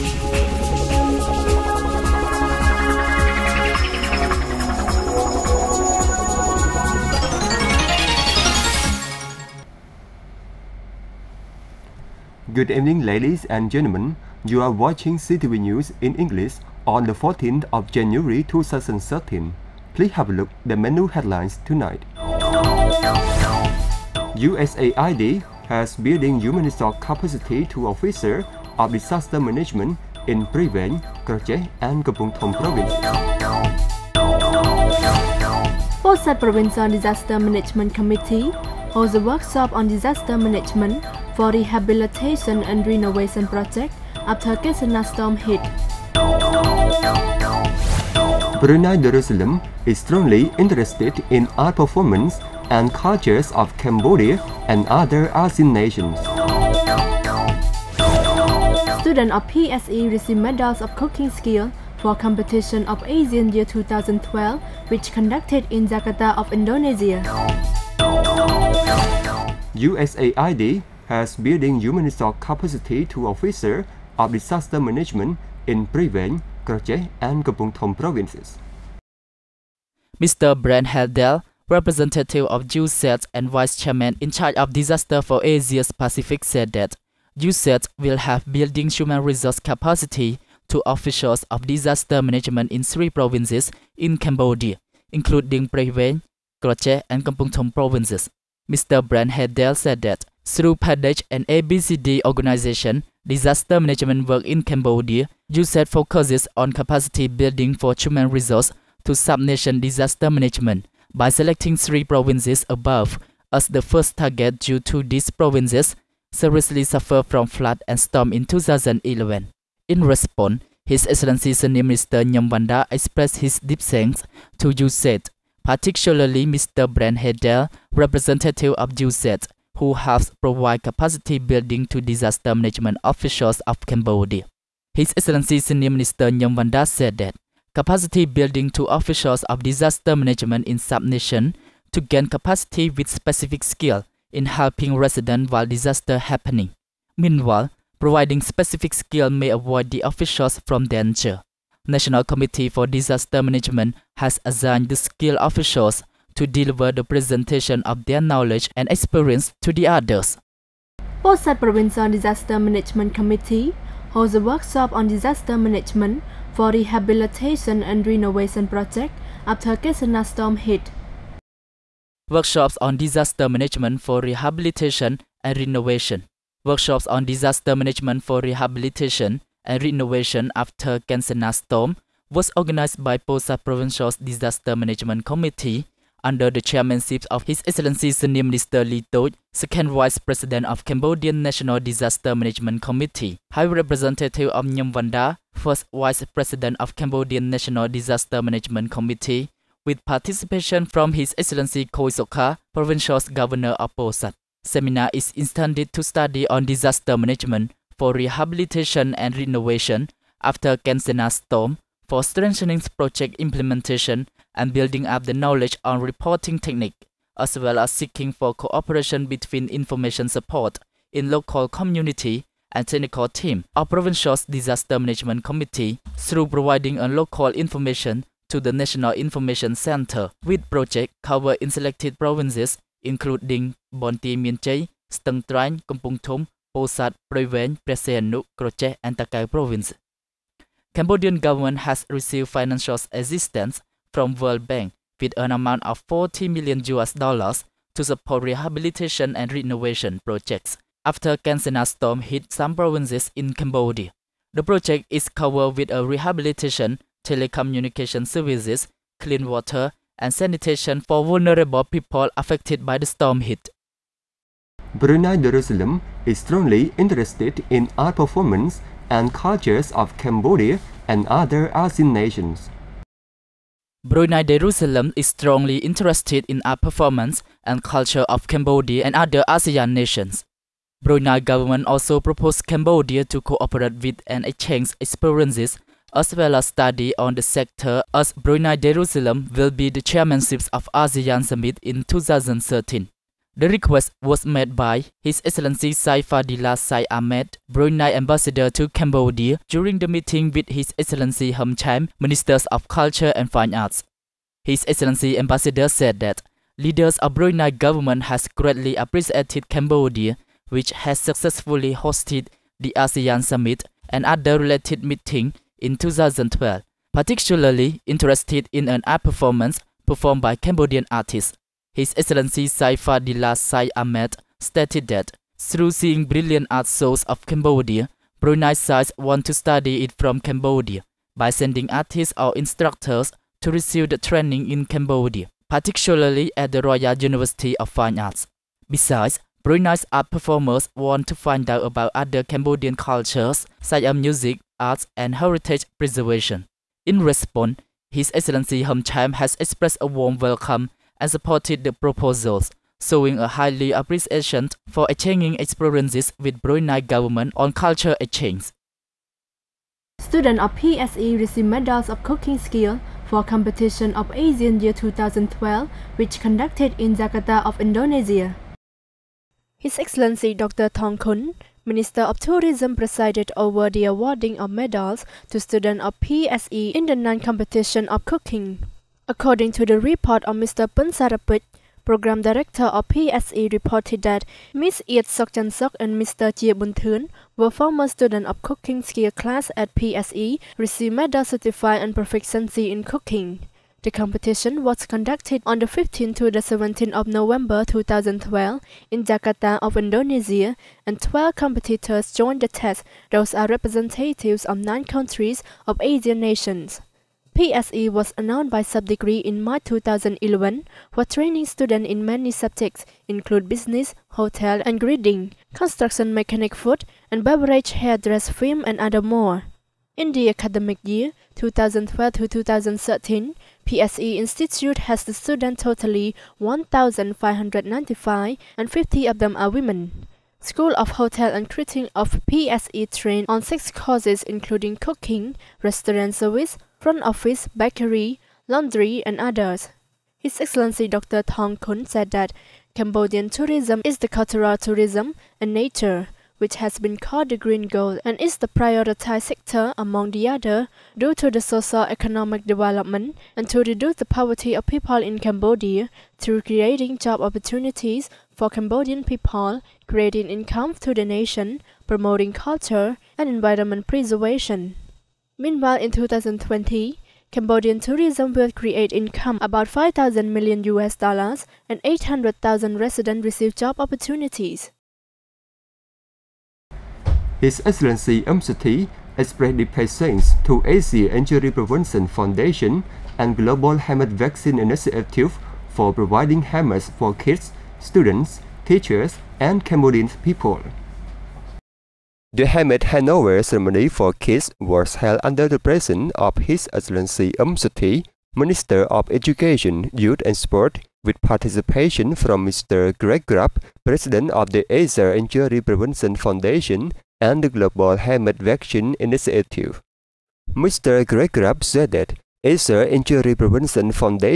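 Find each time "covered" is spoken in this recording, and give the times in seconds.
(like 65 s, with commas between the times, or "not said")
231 s, 255 s.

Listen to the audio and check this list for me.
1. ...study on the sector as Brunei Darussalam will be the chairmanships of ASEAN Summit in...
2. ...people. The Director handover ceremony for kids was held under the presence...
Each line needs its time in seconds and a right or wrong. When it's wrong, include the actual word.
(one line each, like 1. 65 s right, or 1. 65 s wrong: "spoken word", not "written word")
1. 286 s right
2. 490 s wrong: "Hamid", not "Director".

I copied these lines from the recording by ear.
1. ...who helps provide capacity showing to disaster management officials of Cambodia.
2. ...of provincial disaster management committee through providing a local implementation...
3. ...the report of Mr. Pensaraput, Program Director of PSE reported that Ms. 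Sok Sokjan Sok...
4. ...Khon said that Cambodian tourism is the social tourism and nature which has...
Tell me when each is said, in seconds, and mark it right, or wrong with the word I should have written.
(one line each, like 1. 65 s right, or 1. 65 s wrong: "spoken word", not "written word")
1. 129 s wrong: "building", not "showing"
2. 223 s wrong: "information", not "implementation"
3. 379 s right
4. 441 s wrong: "cultural", not "social".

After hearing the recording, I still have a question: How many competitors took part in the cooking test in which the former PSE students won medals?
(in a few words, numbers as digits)
12.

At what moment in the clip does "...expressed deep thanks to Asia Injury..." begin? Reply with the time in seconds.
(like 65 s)
479 s.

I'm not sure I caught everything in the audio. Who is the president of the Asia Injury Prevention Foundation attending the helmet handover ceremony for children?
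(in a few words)
Greg Grubb.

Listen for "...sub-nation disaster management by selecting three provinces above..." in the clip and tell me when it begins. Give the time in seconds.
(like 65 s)
109 s.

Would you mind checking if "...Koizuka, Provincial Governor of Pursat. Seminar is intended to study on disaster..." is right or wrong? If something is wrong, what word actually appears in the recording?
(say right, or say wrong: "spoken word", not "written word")
right.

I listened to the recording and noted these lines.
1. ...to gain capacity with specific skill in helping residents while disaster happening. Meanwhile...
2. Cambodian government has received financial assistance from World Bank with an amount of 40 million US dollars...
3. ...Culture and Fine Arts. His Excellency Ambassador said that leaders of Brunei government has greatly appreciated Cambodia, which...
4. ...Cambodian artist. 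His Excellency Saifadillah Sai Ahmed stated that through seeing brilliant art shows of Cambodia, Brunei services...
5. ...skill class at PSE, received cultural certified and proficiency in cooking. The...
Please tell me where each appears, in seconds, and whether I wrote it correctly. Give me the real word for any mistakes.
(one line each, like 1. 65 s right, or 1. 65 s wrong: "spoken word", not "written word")
1. 141 s right
2. 240 s right
3. 302 s right
4. 320 s wrong: "sides", not "services"
5. 389 s wrong: "medal", not "cultural".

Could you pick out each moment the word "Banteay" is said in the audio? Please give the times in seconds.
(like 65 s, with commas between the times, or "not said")
233 s.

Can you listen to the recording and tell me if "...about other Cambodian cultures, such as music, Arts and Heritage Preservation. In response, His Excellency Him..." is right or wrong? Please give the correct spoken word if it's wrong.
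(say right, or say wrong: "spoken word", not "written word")
right.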